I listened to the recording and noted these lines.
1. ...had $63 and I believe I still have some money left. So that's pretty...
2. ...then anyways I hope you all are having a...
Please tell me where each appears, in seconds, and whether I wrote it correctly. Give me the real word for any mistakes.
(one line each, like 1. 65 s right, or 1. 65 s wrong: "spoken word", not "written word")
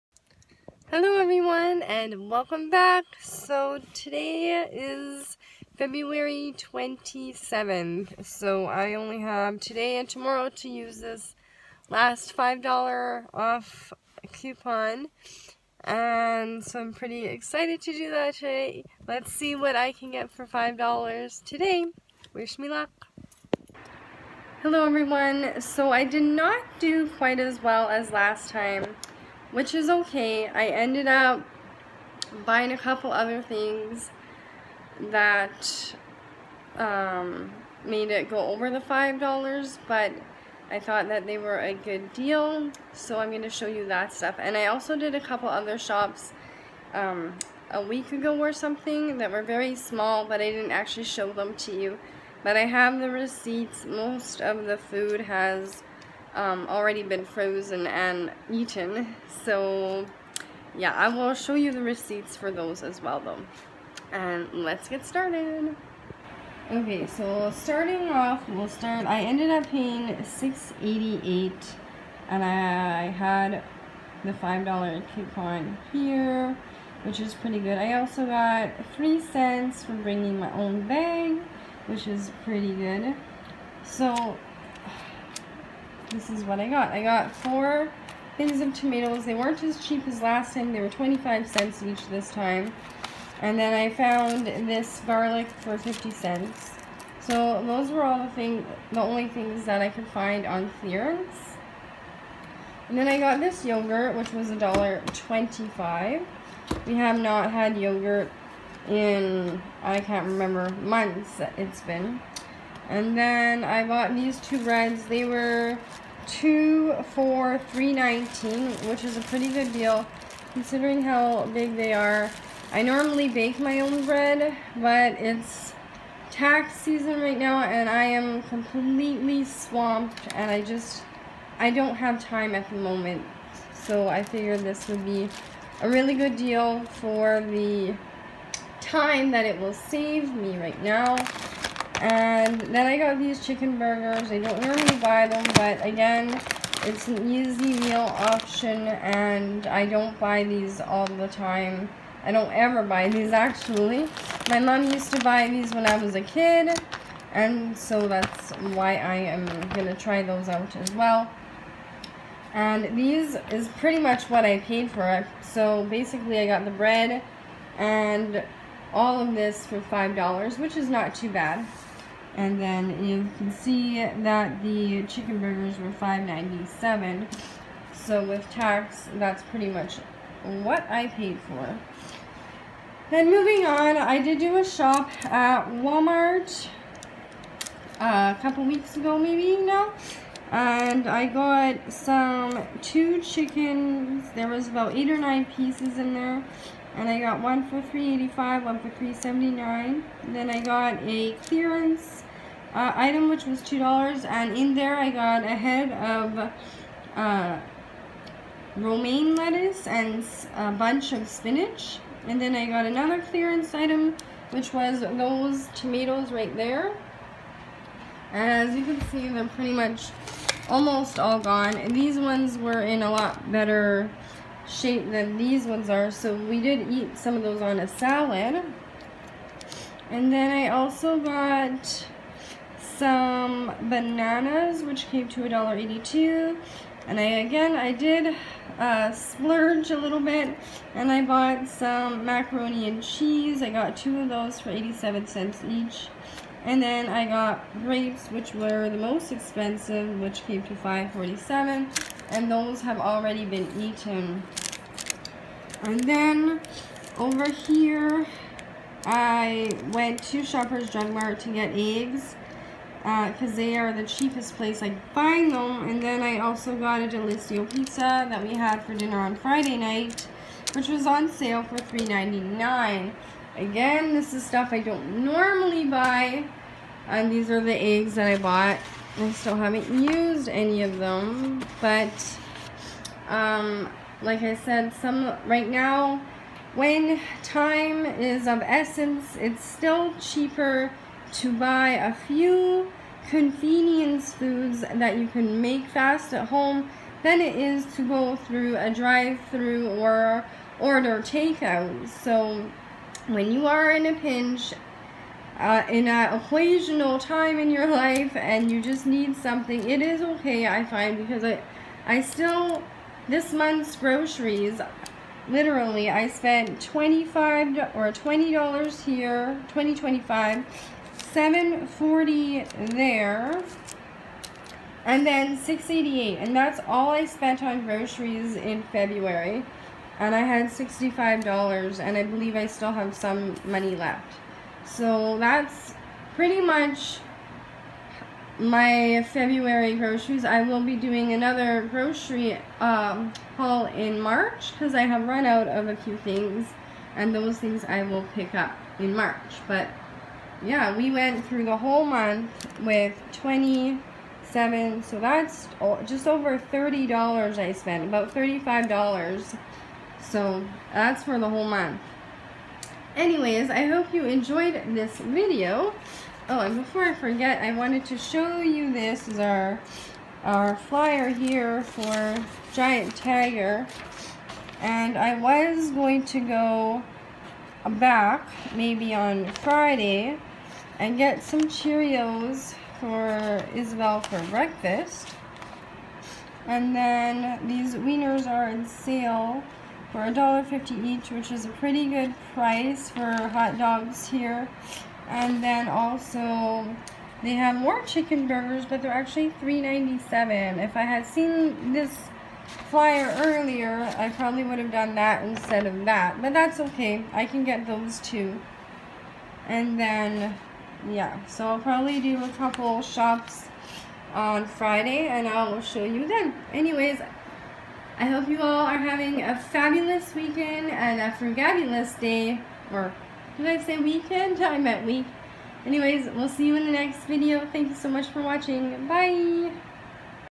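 1. 330 s wrong: "65", not "63"
2. 416 s right.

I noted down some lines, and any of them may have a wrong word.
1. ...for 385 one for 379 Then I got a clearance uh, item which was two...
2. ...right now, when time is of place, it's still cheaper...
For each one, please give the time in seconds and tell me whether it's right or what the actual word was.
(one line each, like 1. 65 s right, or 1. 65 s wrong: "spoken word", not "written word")
1. 197 s right
2. 285 s wrong: "essence", not "place".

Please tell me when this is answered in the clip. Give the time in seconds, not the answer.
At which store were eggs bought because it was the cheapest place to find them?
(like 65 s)
260 s.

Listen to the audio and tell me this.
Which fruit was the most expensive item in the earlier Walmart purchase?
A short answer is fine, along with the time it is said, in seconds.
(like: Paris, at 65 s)
grapes, at 247 s.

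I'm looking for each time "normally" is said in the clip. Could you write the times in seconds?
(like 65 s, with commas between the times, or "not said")
122 s, 144 s, 275 s.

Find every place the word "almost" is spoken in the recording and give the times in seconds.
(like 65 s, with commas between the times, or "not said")
220 s.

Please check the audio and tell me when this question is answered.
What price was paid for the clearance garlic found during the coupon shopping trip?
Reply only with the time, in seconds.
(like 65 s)
95 s.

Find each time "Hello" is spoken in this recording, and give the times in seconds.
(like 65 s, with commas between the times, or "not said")
0 s, 24 s.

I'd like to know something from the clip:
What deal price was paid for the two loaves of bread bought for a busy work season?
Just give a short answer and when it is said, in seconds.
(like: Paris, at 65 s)
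2 for $3.19, at 116 s.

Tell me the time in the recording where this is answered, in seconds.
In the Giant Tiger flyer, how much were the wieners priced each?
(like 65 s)
390 s.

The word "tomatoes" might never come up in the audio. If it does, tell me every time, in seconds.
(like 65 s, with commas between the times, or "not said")
88 s, 215 s.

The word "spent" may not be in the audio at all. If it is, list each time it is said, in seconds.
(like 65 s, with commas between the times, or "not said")
316 s, 327 s, 357 s.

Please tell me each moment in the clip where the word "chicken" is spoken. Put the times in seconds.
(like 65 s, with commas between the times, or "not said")
143 s, 175 s, 193 s, 398 s.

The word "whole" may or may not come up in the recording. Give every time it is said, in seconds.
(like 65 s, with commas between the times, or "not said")
351 s, 361 s.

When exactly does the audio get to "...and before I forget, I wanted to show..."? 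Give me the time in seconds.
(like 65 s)
366 s.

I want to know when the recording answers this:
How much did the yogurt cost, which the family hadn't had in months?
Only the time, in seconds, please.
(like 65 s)
104 s.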